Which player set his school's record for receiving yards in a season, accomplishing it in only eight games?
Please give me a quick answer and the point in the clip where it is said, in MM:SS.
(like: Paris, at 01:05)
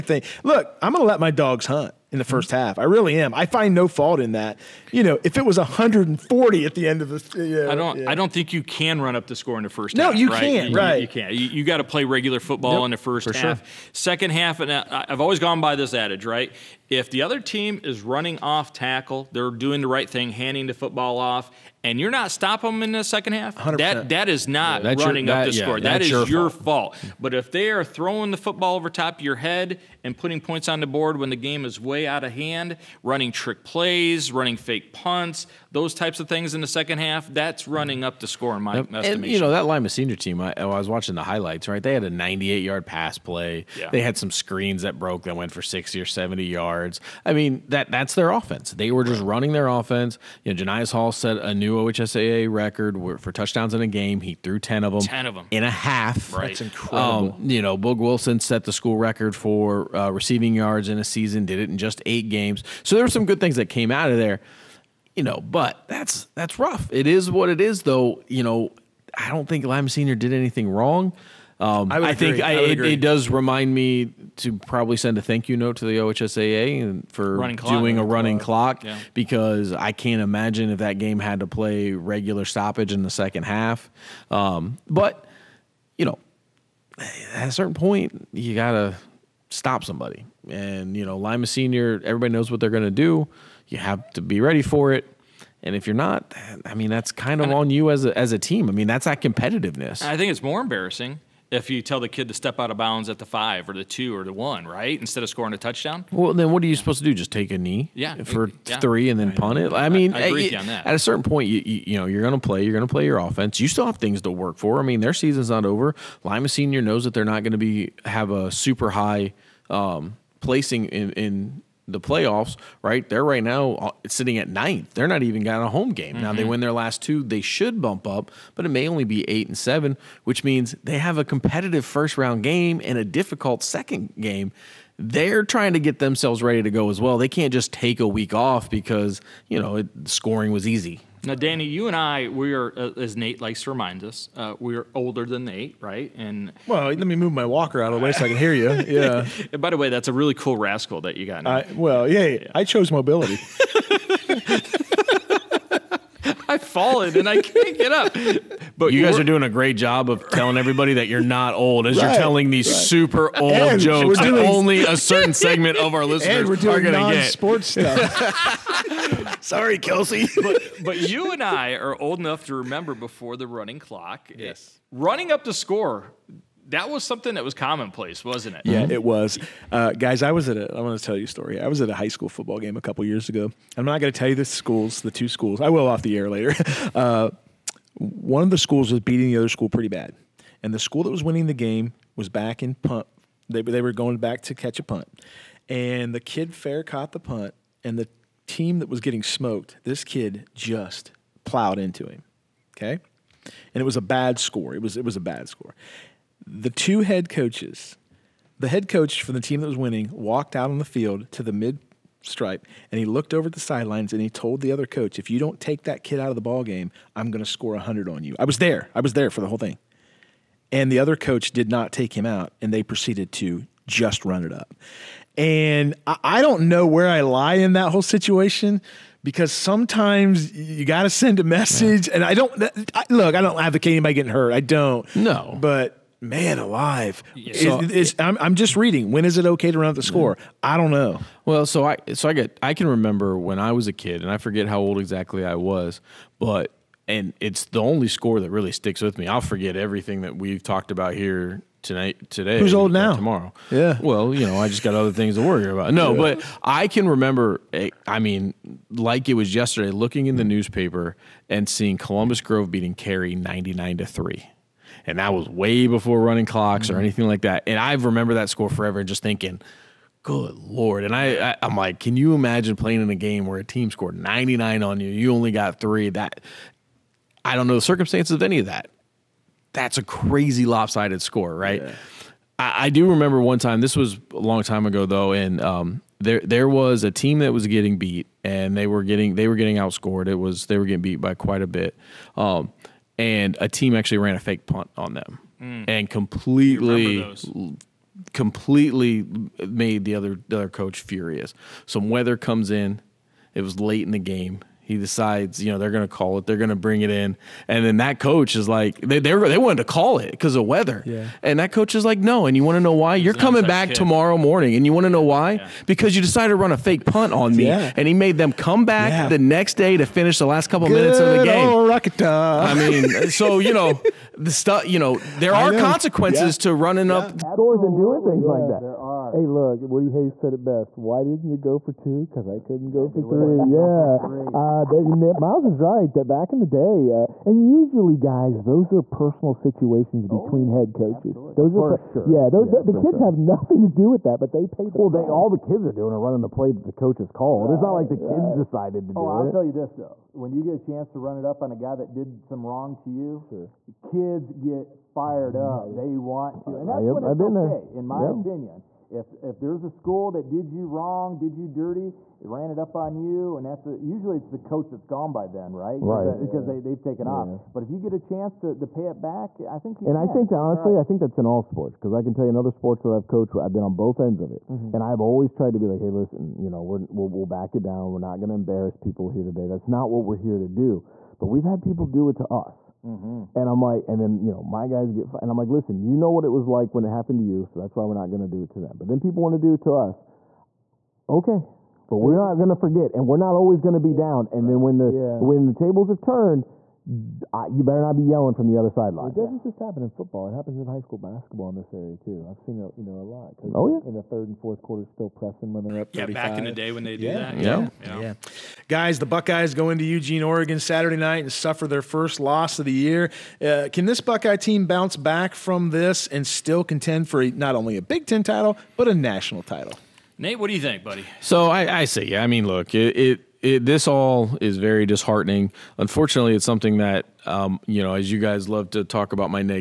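Boog Wilson, at 00:57.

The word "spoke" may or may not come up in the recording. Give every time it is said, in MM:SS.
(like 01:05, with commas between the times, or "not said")
not said.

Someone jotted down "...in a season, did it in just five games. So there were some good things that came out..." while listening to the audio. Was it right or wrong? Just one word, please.
wrong.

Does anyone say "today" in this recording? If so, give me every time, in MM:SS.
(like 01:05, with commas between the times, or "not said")
04:12, 06:19.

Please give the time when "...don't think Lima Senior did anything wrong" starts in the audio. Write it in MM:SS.
01:09.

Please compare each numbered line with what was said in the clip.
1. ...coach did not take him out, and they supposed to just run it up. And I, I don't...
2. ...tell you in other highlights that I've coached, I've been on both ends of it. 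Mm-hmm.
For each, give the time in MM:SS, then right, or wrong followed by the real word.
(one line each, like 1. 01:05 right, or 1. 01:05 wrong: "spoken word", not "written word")
1. 03:41 wrong: "proceeded", not "supposed"
2. 06:12 wrong: "sports", not "highlights".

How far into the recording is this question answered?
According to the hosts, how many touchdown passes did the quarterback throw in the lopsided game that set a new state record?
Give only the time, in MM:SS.
00:54.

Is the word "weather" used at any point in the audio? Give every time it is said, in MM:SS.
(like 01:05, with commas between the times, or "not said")
05:02, 05:10.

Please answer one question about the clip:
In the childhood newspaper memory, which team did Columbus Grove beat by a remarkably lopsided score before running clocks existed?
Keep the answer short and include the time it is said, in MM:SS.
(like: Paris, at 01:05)
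Cary, at 04:22.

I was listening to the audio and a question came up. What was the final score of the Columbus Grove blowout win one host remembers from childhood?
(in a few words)
99 to 3.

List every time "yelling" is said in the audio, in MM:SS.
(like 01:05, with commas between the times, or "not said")
06:38.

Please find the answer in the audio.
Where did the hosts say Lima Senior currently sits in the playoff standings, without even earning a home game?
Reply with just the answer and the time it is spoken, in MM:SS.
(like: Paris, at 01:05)
Ninth, at 02:04.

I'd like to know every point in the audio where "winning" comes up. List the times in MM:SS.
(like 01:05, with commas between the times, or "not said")
03:11, 03:29.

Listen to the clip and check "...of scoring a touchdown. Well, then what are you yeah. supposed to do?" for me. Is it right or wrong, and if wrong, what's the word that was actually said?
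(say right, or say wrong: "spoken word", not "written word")
right.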